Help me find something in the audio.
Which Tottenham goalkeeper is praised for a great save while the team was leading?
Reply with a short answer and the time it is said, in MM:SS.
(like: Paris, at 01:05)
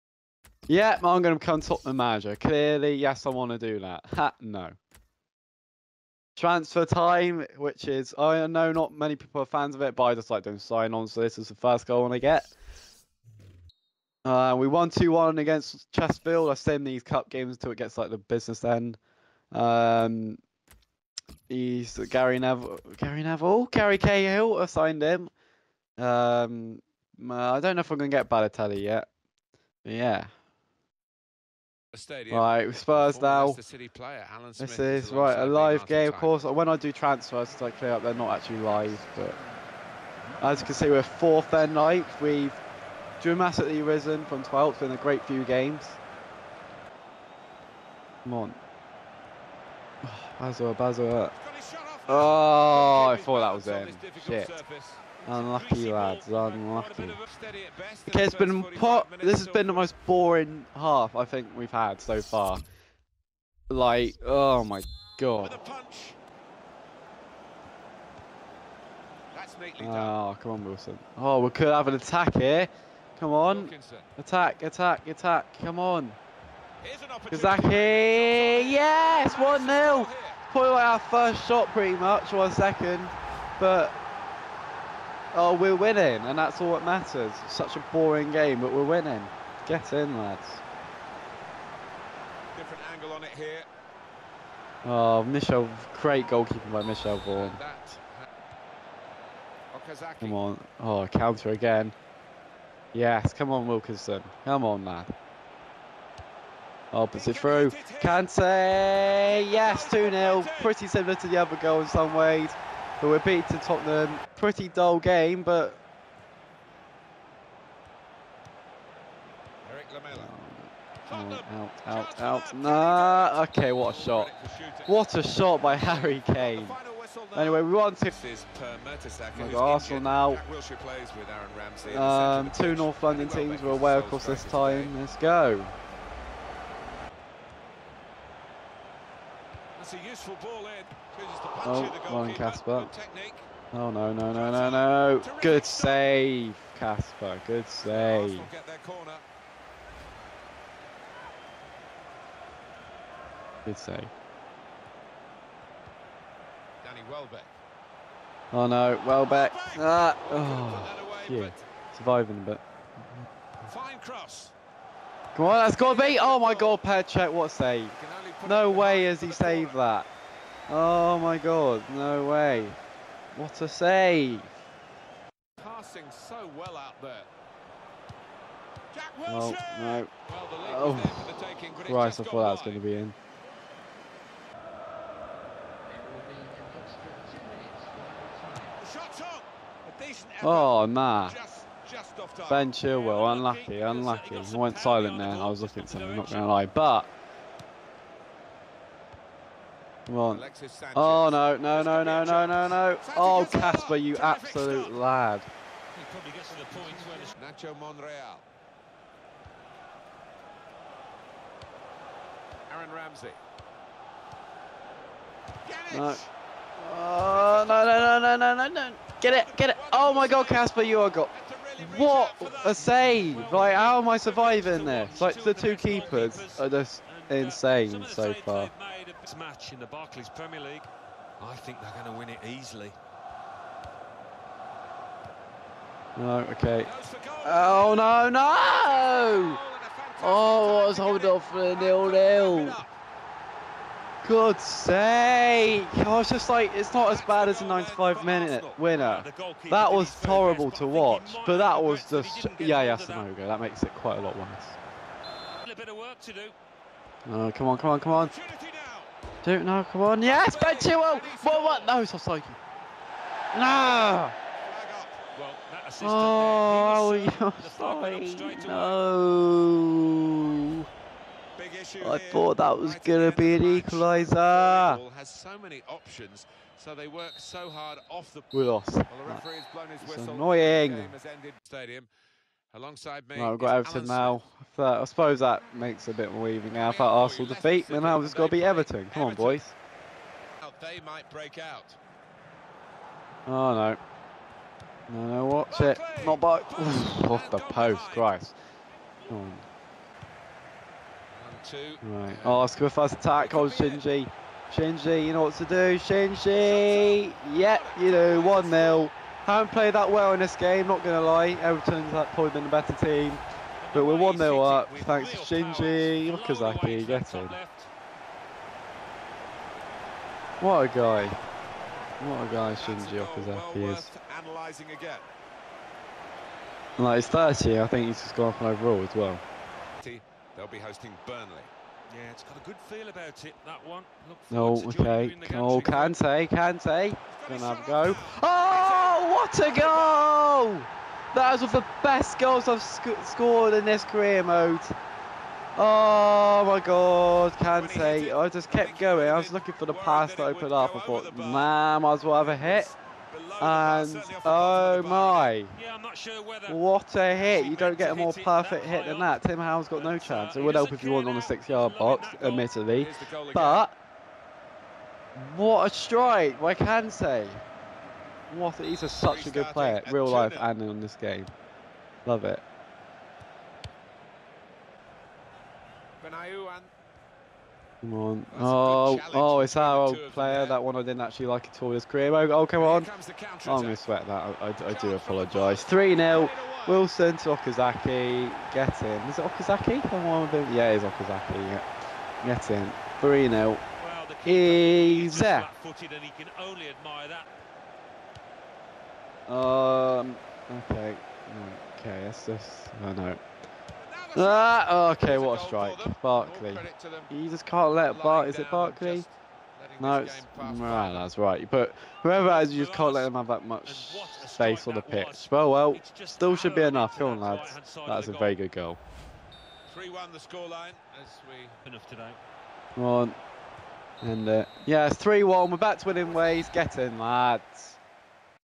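Michel Vorm, at 01:36.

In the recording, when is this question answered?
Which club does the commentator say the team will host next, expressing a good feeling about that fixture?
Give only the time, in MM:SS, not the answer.
05:31.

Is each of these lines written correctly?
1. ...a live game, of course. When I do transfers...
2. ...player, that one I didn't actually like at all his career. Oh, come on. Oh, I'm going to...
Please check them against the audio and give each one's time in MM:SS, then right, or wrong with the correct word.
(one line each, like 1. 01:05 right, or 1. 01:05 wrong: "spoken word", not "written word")
1. 00:35 right
2. 06:20 right.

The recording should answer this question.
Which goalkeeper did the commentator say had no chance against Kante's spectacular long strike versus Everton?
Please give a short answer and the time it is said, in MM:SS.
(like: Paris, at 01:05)
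Tim Howard, at 05:59.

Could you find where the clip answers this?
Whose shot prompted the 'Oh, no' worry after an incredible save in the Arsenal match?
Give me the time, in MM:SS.
02:36.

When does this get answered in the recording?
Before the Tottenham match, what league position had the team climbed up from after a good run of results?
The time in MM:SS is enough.
00:44.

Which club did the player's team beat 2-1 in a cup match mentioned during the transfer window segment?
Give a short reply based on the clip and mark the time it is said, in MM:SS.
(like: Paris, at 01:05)
Chesterfield, at 00:15.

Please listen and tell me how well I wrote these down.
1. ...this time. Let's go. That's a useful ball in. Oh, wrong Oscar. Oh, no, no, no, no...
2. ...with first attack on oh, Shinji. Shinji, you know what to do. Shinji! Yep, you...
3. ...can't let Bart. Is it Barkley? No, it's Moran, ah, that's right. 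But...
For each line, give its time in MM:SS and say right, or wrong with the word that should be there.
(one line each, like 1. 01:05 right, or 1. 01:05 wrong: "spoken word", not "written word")
1. 02:14 wrong: "Kasper", not "Oscar"
2. 05:02 right
3. 06:47 right.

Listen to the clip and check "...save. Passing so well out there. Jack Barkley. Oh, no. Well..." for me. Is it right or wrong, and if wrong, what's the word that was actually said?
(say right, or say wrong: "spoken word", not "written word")
wrong: "Wilshere", not "Barkley".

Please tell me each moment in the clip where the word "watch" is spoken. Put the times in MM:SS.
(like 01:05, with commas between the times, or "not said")
04:10, 04:55.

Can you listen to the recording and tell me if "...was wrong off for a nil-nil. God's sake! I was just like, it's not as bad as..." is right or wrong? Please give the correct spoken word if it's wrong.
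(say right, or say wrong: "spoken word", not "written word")
wrong: "holding", not "wrong".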